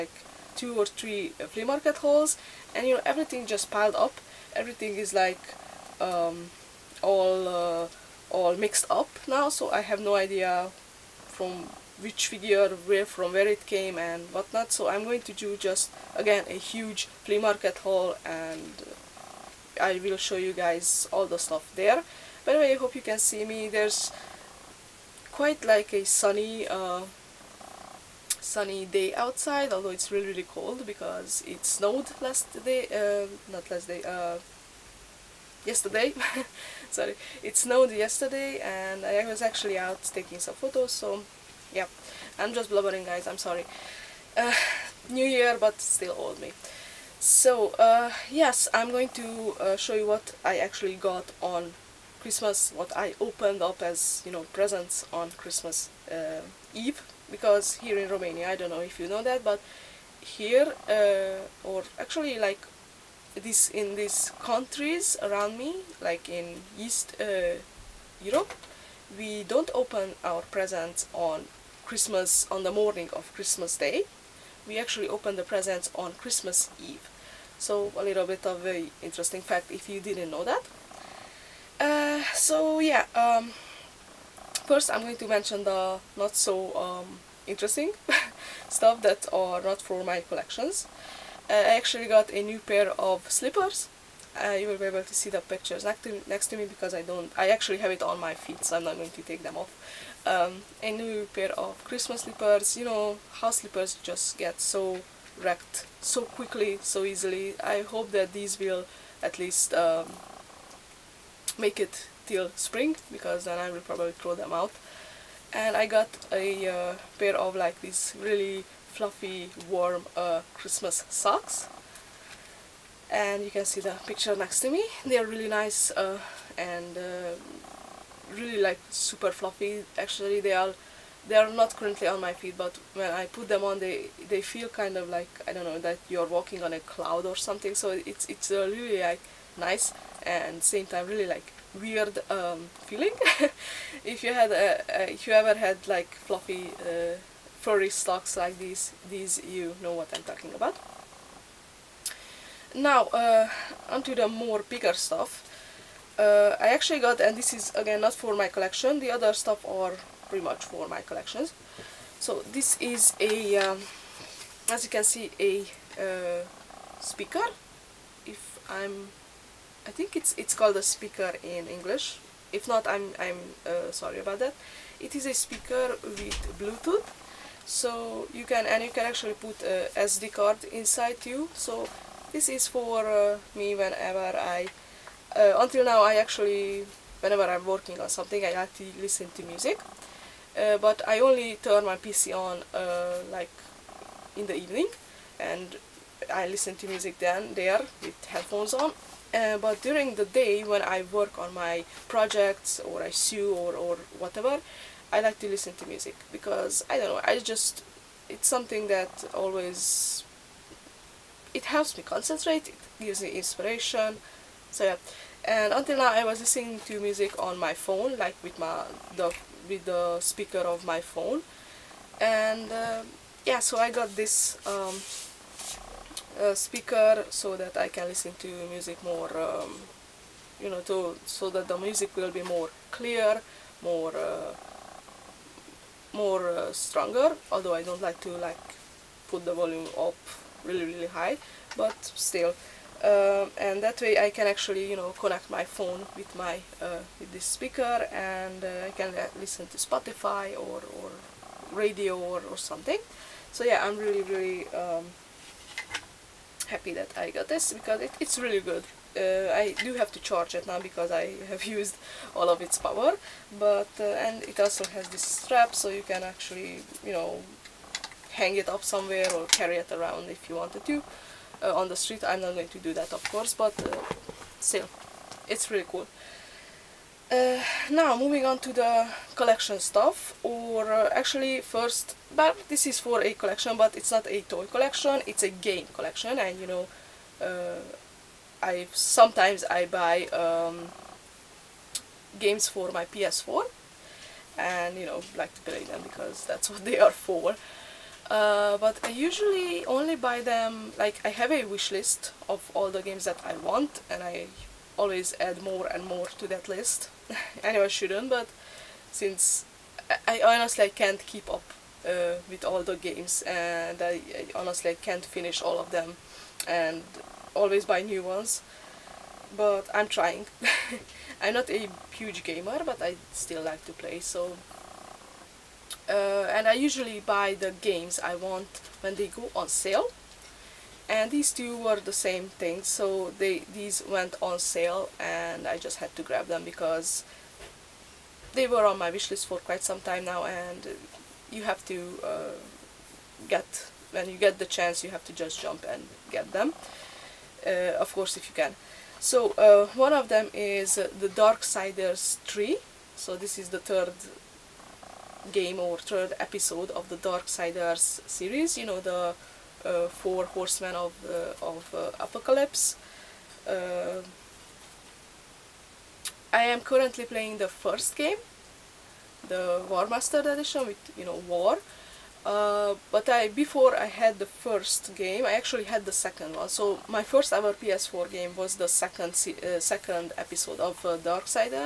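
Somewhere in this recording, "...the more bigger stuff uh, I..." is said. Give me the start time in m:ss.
2:34.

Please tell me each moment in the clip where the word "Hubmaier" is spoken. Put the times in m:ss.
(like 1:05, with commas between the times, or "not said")
not said.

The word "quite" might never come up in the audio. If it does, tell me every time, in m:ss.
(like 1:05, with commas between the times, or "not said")
0:25, 5:39.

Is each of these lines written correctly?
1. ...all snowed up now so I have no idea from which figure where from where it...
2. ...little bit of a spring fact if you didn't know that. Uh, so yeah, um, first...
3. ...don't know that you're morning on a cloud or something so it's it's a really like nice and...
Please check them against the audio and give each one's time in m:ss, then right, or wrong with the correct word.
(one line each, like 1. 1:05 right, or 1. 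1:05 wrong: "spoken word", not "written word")
1. 0:08 wrong: "mixed", not "snowed"
2. 1:18 wrong: "interesting", not "spring"
3. 2:15 wrong: "walking", not "morning".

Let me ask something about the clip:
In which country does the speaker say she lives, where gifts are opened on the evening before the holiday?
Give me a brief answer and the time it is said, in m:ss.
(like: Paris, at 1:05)
Romania, at 0:58.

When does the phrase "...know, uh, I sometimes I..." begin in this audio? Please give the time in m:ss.
4:46.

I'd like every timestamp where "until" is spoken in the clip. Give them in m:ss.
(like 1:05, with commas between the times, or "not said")
3:05, 3:35.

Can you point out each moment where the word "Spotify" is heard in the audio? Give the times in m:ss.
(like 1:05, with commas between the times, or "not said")
4:09.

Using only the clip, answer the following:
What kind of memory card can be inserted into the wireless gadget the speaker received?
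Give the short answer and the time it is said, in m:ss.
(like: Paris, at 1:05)
SD card, at 2:59.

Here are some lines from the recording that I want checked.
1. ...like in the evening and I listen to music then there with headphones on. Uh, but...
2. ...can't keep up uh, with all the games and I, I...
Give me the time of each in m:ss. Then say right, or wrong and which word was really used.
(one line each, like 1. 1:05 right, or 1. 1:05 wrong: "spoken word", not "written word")
1. 3:13 right
2. 5:10 right.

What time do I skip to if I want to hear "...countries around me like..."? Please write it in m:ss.
1:04.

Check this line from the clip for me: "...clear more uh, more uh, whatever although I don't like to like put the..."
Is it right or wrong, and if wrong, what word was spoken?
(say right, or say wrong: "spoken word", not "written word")
wrong: "stronger", not "whatever".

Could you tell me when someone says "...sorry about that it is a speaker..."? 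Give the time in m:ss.
2:53.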